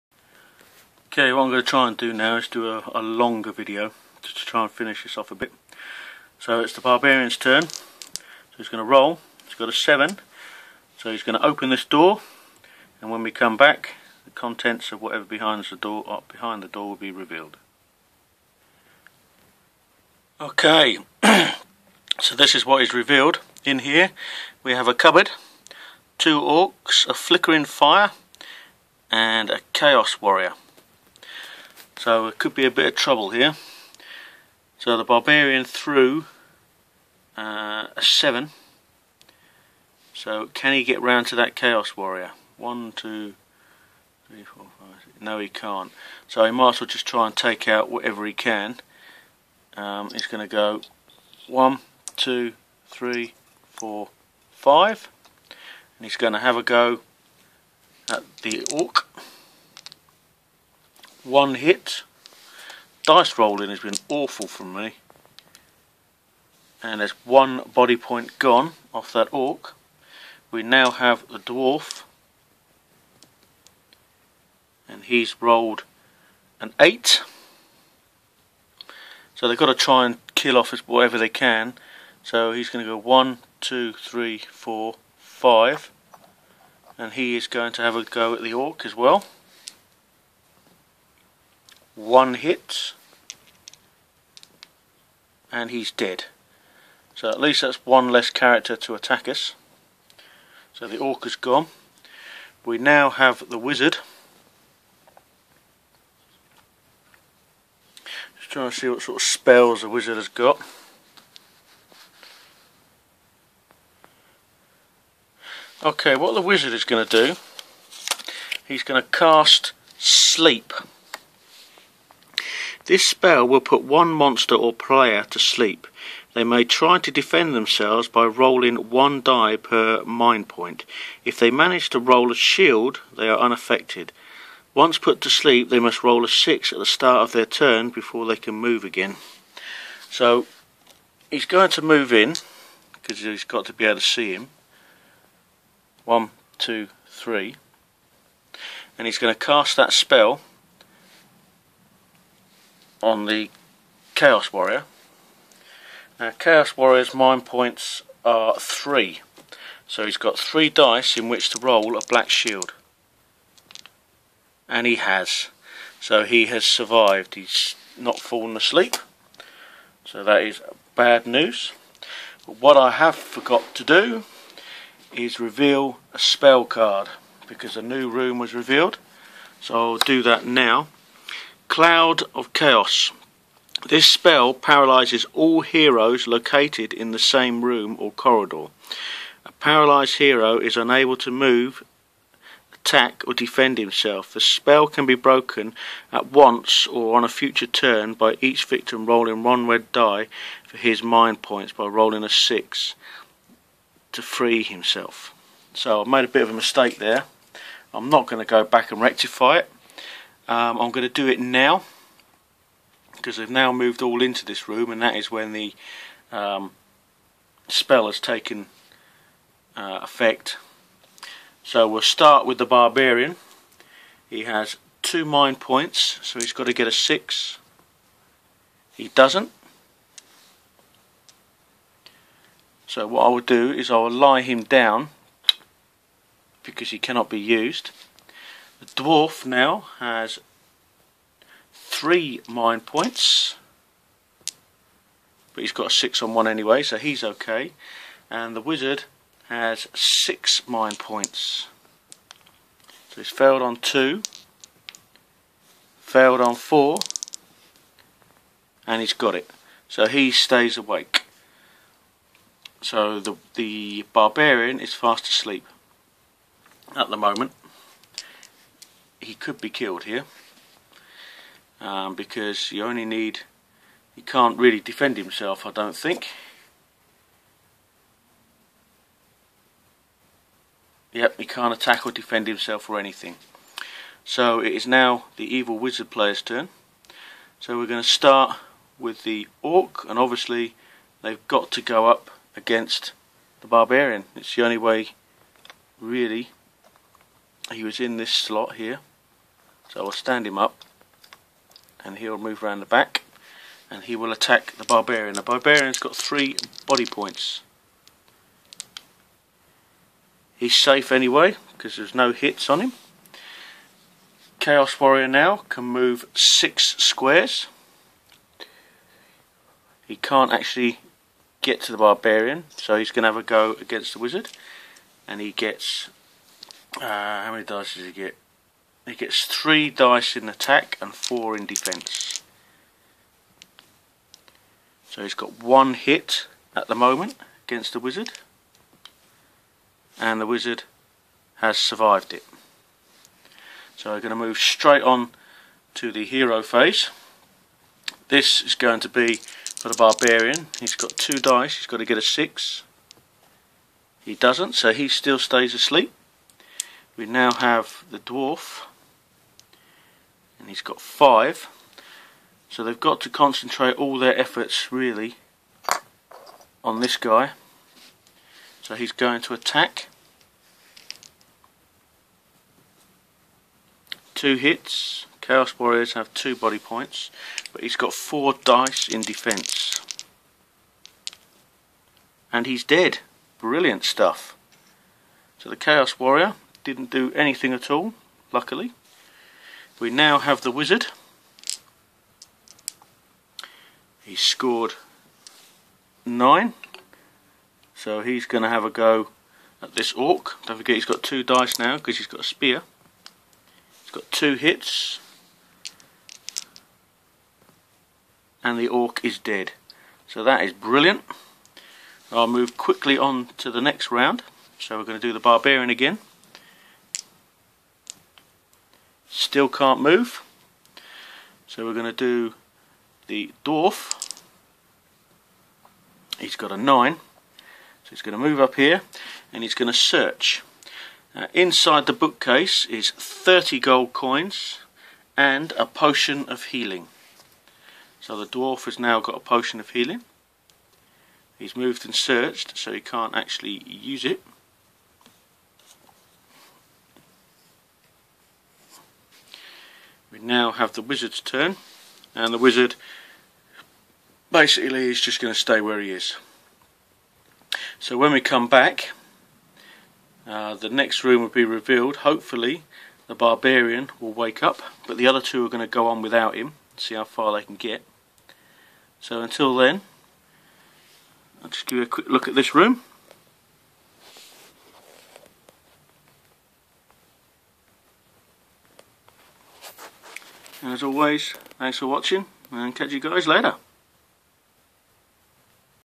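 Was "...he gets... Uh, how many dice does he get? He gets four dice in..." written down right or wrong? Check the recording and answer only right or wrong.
wrong.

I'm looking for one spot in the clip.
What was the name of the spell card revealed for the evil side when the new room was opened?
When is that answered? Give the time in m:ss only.
3:01.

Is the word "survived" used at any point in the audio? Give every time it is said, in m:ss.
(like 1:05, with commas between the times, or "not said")
2:46, 5:41.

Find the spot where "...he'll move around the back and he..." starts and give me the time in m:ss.
5:02.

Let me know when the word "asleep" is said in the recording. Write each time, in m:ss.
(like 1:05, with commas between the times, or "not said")
2:48, 4:25, 5:55.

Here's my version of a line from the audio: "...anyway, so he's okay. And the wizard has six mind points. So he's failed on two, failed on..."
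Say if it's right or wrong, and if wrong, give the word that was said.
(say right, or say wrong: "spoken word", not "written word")
right.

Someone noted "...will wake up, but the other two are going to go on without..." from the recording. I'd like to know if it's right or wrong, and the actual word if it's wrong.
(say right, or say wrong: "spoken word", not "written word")
right.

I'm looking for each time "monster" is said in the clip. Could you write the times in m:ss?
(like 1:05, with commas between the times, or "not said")
2:04.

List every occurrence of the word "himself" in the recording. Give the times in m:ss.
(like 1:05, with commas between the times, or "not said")
3:13, 3:24, 4:35, 4:42.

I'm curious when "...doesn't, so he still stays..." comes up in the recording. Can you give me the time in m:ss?
5:54.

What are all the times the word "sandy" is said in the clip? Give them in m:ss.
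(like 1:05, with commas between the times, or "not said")
not said.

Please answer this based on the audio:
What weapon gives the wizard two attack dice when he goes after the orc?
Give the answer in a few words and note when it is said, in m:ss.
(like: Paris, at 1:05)
A spear, at 6:42.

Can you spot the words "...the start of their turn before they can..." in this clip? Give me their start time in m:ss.
2:16.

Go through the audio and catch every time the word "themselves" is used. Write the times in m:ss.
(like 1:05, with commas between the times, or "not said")
2:07.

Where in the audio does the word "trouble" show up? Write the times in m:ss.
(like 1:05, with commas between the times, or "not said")
0:32.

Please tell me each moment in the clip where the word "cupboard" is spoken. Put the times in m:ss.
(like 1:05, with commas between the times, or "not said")
0:24.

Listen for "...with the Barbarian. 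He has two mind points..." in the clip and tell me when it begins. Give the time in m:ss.
3:42.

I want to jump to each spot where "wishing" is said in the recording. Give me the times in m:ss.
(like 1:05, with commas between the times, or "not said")
not said.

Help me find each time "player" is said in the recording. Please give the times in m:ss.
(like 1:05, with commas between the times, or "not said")
2:04, 4:46.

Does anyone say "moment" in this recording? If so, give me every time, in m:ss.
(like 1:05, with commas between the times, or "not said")
4:27, 5:36.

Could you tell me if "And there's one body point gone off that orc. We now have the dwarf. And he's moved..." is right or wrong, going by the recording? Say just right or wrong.
wrong.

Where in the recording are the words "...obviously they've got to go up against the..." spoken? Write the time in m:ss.
4:50.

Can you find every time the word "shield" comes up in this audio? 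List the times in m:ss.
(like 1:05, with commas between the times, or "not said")
2:12, 2:42.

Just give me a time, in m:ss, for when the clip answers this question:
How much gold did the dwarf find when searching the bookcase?
7:13.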